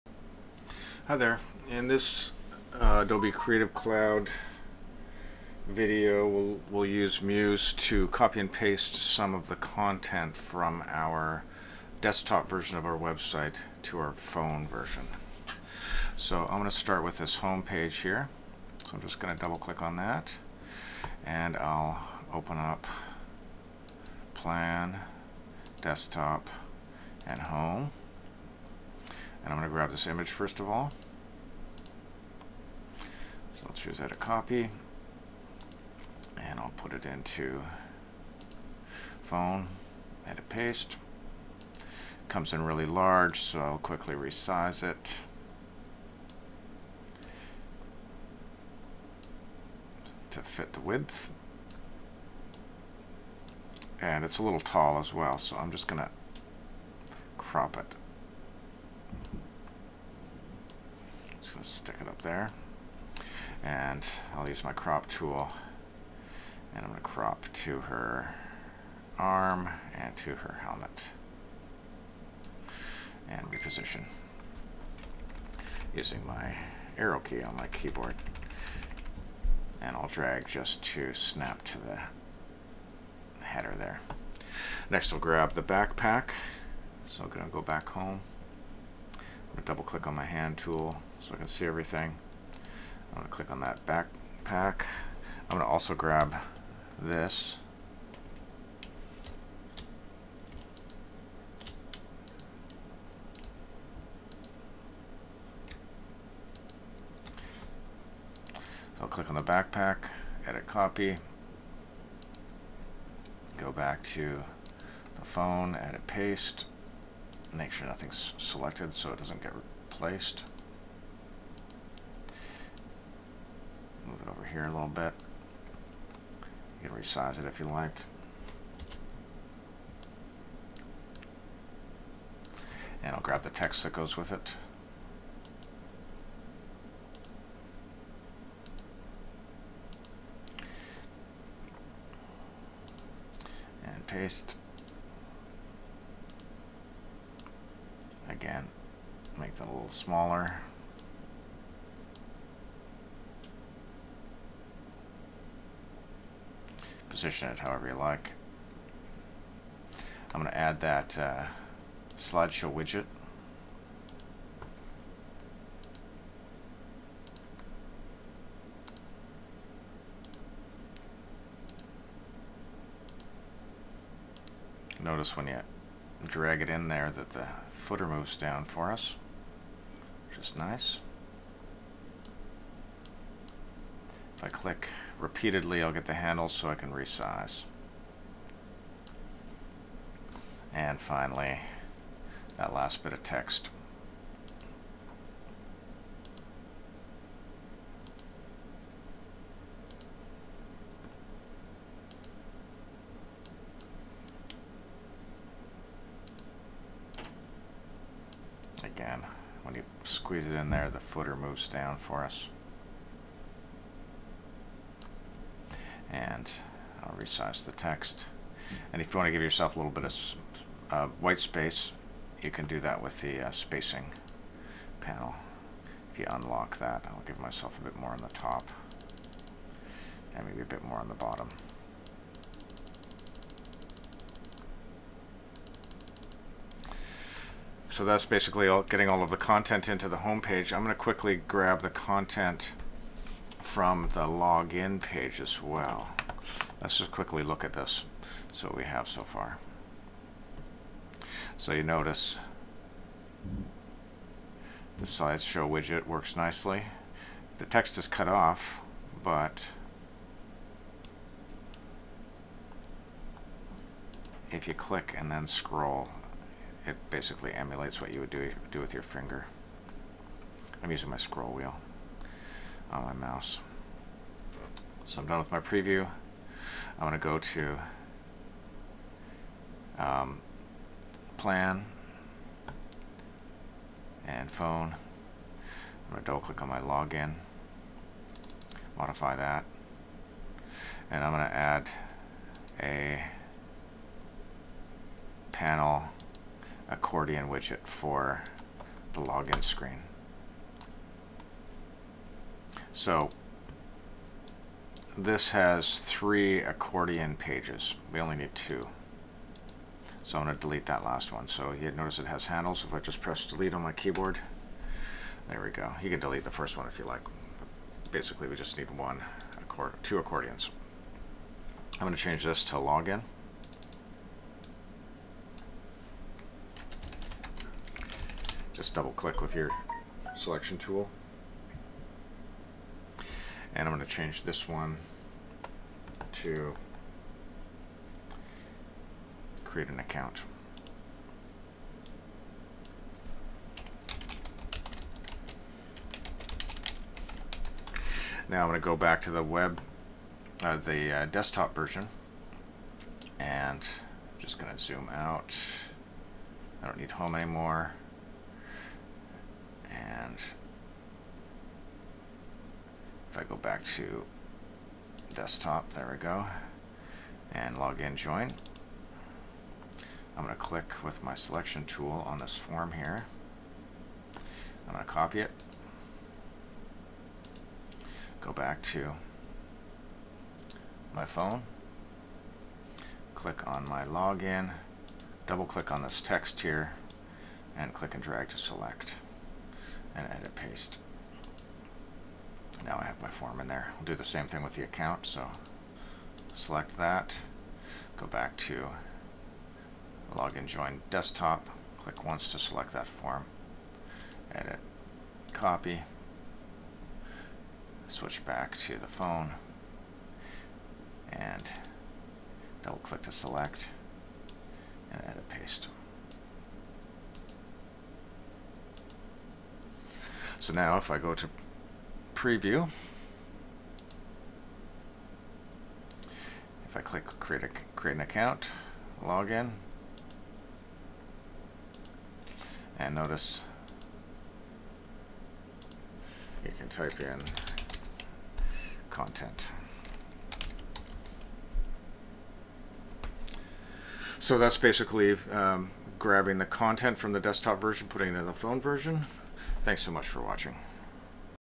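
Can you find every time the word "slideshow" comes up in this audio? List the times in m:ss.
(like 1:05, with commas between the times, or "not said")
2:42, 4:15.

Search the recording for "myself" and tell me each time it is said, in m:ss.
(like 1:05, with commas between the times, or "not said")
3:47.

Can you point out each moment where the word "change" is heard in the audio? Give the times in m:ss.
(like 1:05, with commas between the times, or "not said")
5:22, 5:34.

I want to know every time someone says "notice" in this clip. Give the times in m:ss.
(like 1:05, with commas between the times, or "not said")
2:55, 4:11, 5:11, 7:13.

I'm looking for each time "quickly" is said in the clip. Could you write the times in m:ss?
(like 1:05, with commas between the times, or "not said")
0:43, 4:00, 4:07.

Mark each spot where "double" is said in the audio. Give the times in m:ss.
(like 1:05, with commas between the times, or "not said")
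0:19, 1:29, 4:46, 5:28, 6:25, 6:52.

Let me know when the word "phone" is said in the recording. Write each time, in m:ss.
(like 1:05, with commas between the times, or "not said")
0:14, 0:39, 1:55, 4:44, 6:21, 6:49, 7:28.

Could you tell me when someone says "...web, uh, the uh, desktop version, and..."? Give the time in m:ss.
5:49.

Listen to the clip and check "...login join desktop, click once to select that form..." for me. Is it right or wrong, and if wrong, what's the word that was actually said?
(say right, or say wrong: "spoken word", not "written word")
right.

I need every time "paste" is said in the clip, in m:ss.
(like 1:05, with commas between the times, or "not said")
0:08, 0:40, 1:56, 2:24, 6:30, 6:55.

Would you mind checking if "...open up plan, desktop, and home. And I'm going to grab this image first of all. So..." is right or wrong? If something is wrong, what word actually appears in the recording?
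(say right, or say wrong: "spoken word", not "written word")
right.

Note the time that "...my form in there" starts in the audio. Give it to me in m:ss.
6:33.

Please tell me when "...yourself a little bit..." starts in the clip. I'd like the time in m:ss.
3:39.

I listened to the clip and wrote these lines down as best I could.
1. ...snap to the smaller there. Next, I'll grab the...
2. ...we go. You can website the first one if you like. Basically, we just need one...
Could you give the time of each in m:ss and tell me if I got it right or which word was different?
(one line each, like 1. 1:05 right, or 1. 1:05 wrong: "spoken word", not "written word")
1. 1:21 wrong: "header", not "smaller"
2. 5:15 wrong: "delete", not "website".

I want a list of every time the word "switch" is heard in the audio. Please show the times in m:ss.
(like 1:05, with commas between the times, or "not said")
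6:48.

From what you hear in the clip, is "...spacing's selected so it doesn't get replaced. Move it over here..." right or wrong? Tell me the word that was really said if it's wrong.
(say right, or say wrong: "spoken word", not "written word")
wrong: "nothing", not "spacing".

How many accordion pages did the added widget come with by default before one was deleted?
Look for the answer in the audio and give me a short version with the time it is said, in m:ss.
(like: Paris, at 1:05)
3, at 5:06.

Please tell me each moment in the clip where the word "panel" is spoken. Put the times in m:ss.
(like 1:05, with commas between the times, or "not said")
3:44, 4:55.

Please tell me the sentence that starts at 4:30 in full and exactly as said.
I'm using my scroll wheel on my mouse.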